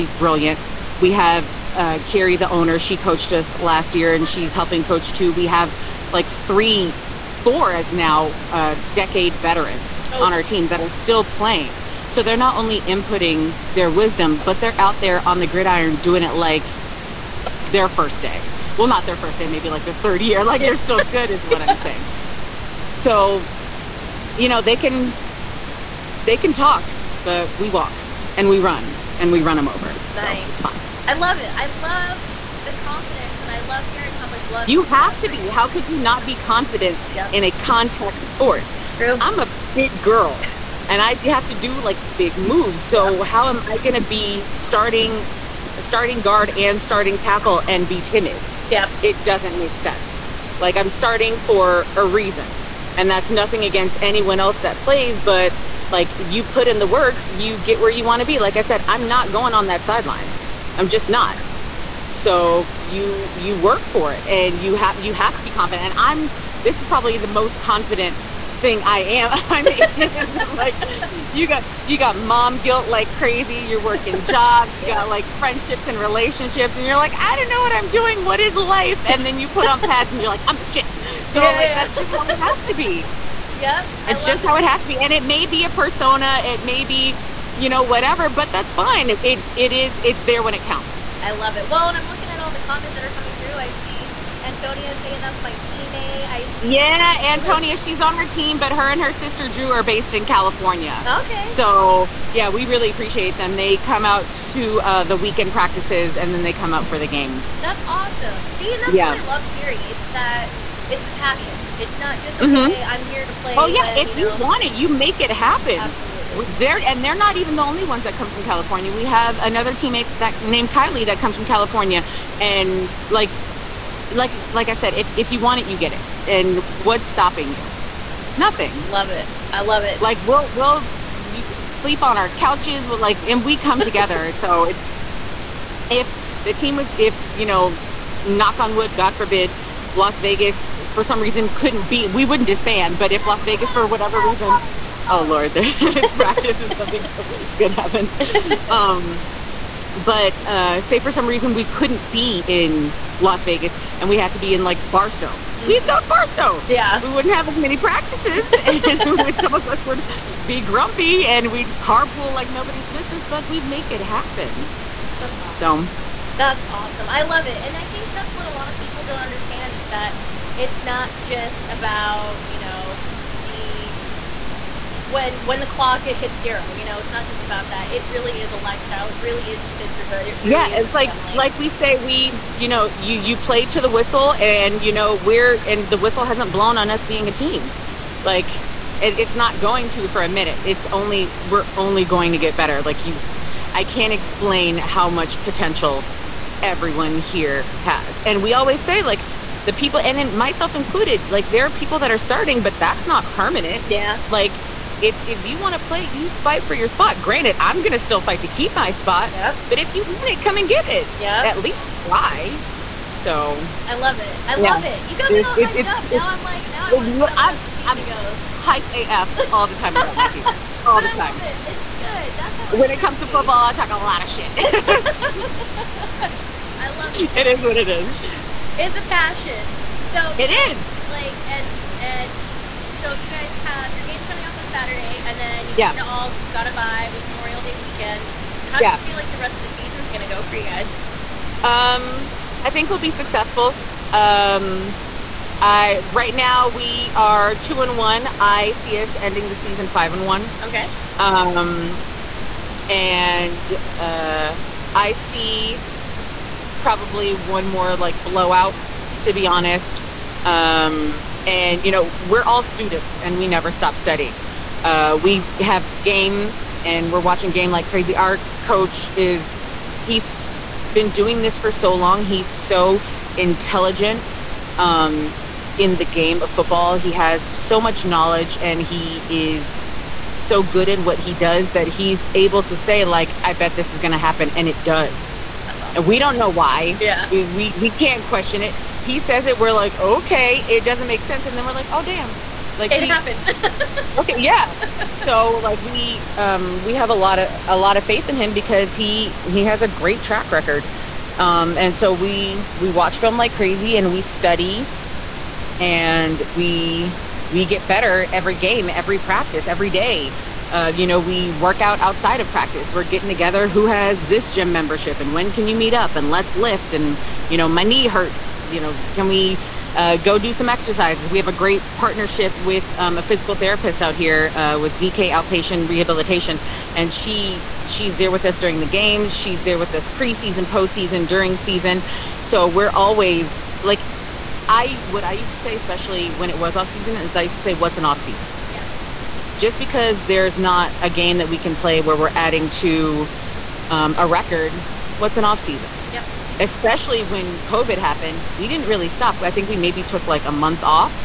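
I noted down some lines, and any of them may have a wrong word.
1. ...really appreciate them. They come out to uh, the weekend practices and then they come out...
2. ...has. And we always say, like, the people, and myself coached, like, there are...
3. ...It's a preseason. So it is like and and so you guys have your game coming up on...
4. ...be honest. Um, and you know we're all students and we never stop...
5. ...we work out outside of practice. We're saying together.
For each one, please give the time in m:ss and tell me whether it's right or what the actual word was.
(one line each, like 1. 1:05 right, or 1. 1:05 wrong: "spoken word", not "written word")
1. 1:42 right
2. 3:17 wrong: "included", not "coached"
3. 3:48 wrong: "passion", not "preseason"
4. 4:19 right
5. 5:11 wrong: "getting", not "saying".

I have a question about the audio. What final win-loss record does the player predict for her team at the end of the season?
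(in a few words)
5 and 1.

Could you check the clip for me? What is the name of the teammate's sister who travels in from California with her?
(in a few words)
Drew.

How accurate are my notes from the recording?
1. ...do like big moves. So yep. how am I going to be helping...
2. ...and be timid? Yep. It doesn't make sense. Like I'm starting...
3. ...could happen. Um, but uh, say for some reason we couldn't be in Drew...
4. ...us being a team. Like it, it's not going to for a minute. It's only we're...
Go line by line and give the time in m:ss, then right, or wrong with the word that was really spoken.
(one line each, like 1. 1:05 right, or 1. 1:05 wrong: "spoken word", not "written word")
1. 0:41 wrong: "starting", not "helping"
2. 0:47 right
3. 2:27 wrong: "Las", not "Drew"
4. 3:06 right.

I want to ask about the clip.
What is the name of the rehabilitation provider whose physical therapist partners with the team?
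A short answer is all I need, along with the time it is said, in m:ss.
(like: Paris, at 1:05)
ZK Outpatient Rehabilitation, at 5:24.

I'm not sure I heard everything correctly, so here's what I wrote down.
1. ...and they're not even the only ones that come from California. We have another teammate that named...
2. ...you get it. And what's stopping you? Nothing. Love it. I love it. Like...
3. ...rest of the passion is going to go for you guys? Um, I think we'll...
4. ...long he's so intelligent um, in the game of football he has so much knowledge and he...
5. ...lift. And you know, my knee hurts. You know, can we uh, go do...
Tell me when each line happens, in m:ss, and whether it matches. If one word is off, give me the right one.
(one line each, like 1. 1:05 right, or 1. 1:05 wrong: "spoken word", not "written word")
1. 1:56 right
2. 2:05 right
3. 3:59 wrong: "season", not "passion"
4. 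4:31 right
5. 5:16 right.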